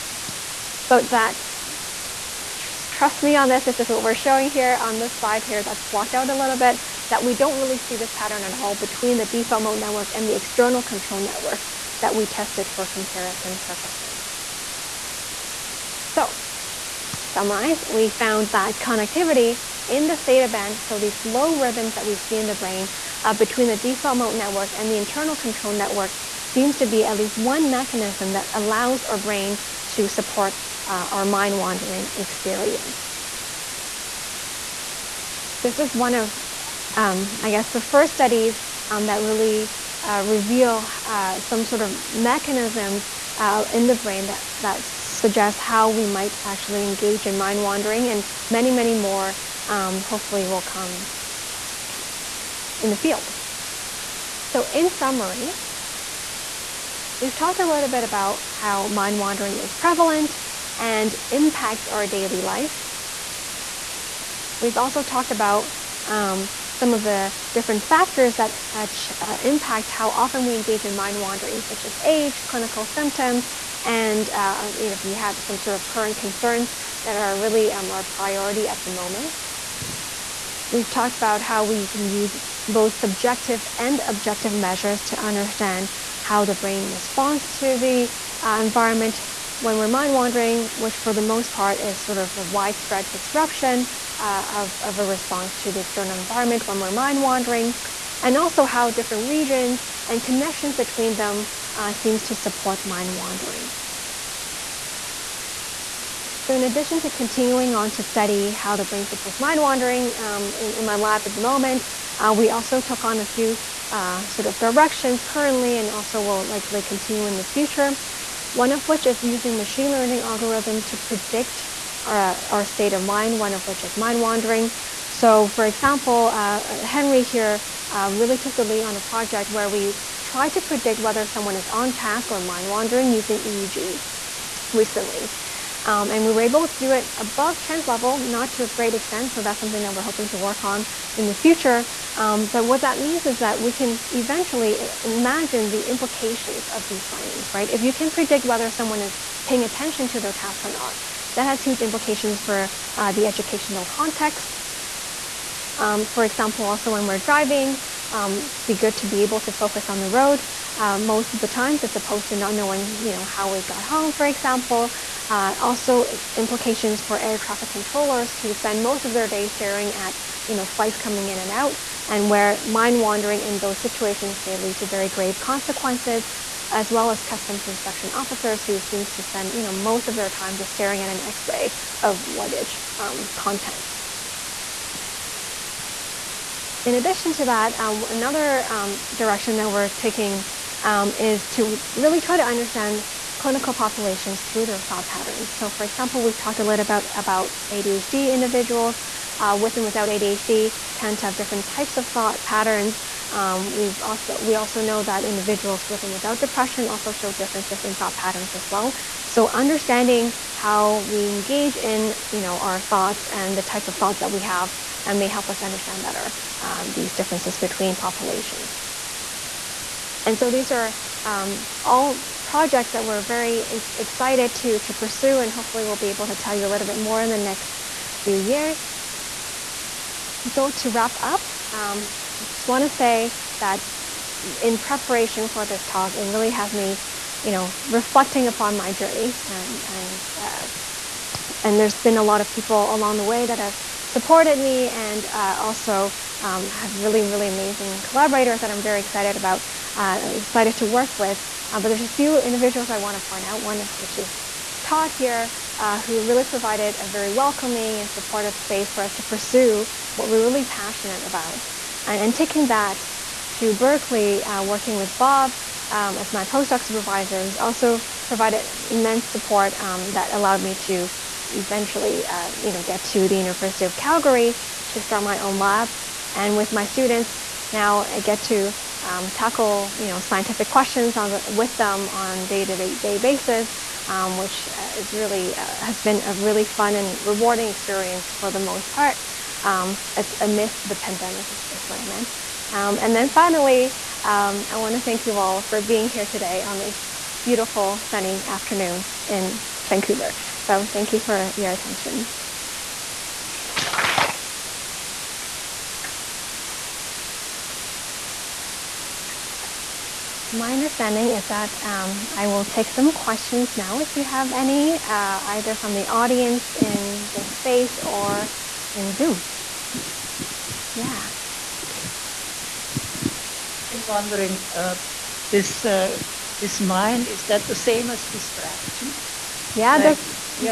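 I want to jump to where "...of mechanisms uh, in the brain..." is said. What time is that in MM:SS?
00:41.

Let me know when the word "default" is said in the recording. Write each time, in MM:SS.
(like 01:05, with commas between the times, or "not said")
00:09, 00:23.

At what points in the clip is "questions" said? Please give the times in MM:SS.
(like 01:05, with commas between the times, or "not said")
04:40, 05:13.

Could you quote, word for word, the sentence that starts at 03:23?
Um, we've also, we also know that individuals with and without depression also show differences in thought patterns as well.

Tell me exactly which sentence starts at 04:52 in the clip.
Um, and then finally, um, I want to thank you all for being here today on this beautiful sunny afternoon in Vancouver.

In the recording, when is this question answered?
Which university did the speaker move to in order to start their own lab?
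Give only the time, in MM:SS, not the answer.
04:33.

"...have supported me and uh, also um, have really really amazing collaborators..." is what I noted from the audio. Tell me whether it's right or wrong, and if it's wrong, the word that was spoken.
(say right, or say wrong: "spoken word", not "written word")
right.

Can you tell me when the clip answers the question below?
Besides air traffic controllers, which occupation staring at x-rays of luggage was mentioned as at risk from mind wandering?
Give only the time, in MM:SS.
02:57.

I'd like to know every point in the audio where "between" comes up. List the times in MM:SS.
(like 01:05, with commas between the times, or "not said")
00:08, 00:23, 01:40, 03:37.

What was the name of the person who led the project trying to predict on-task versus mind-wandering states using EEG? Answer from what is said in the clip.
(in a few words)
Henry.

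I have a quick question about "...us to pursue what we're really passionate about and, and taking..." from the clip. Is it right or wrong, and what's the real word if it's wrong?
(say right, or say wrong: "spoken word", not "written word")
right.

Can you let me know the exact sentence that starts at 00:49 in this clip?
Um, hopefully, will come in the field.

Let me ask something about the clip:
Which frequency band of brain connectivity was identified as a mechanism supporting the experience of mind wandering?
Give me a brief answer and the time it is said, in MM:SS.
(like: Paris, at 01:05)
Theta band, at 00:20.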